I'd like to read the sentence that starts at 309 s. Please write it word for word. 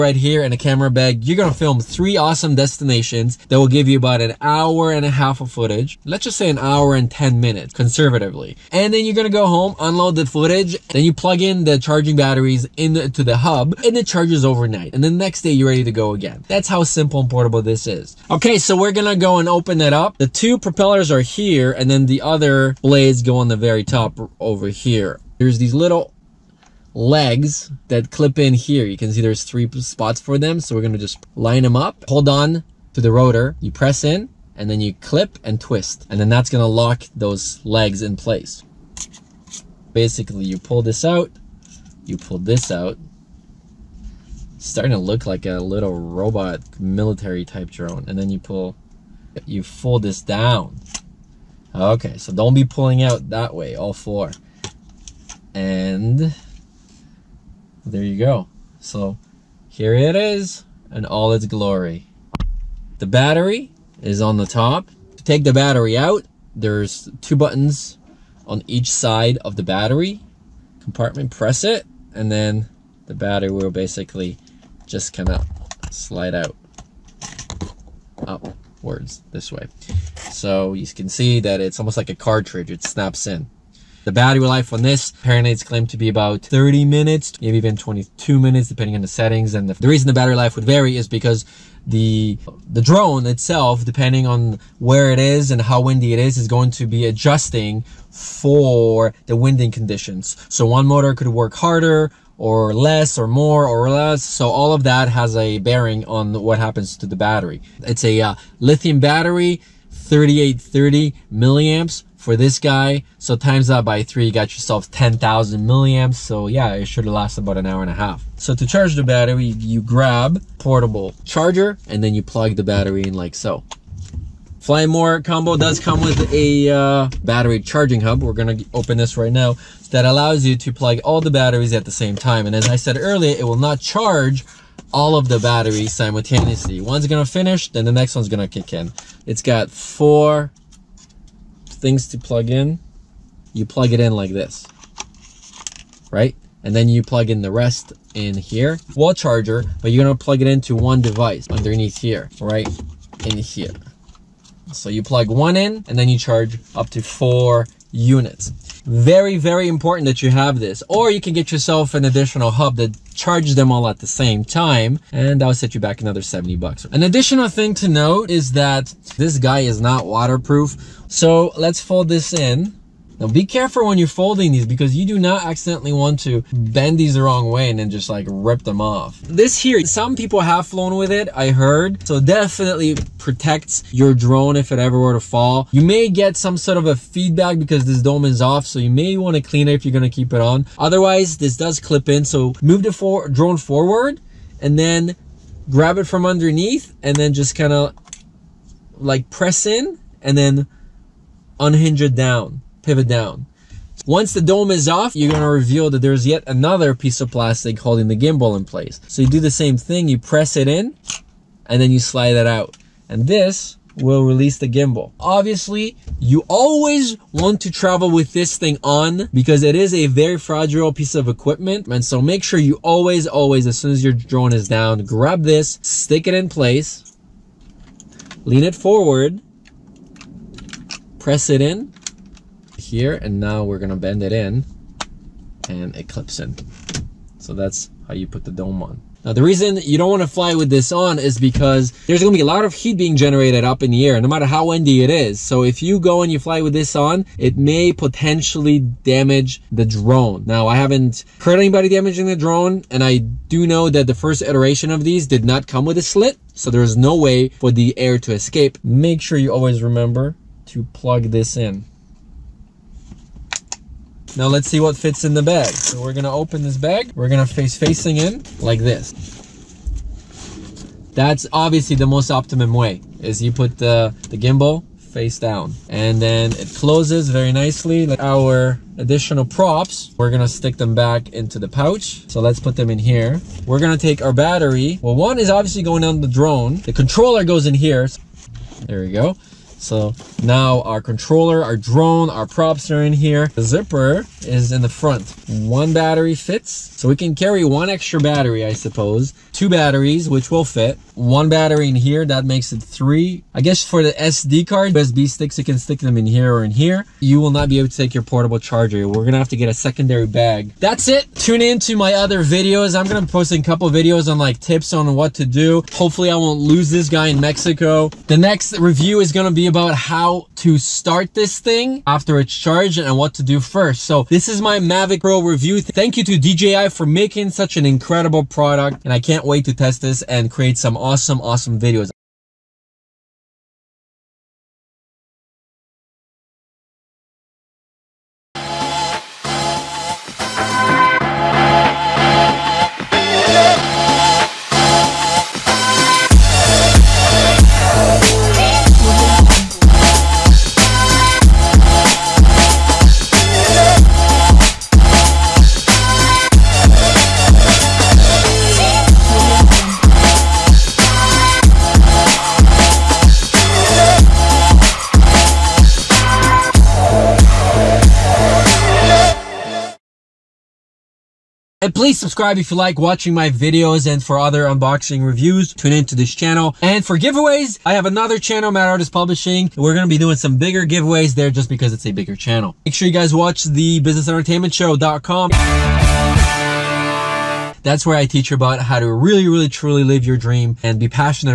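We're gonna have to get a secondary bag.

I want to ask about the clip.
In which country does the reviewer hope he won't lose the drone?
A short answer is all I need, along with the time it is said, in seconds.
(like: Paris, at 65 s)
Mexico, at 317 s.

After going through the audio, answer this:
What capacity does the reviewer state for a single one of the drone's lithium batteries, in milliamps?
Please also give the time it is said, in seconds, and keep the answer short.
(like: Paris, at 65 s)
3830 milliamps, at 110 s.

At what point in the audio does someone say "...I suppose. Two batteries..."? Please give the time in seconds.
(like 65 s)
298 s.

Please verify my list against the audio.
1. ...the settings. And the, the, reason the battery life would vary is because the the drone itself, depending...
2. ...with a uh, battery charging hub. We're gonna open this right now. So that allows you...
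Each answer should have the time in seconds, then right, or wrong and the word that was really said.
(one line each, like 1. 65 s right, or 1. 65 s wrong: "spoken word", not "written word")
1. 89 s right
2. 126 s right.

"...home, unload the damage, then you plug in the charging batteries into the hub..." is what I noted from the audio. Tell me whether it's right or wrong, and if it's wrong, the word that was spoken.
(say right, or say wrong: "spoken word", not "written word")
wrong: "footage", not "damage".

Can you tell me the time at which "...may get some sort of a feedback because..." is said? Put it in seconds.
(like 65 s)
185 s.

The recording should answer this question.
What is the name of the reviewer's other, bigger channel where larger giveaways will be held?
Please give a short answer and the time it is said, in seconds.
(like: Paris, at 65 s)
Mad Artist Publishing, at 378 s.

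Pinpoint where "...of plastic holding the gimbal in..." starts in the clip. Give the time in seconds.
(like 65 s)
207 s.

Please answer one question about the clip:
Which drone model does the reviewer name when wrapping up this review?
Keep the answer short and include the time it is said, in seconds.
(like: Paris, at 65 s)
Mavic Pro, at 324 s.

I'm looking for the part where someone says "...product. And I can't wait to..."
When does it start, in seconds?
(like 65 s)
328 s.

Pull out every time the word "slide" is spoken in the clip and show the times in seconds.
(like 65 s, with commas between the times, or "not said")
75 s, 211 s.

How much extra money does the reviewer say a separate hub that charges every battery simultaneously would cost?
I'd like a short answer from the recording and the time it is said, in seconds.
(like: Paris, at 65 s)
70 bucks, at 166 s.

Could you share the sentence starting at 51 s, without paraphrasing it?
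Okay, so don't be pulling out that way, all four.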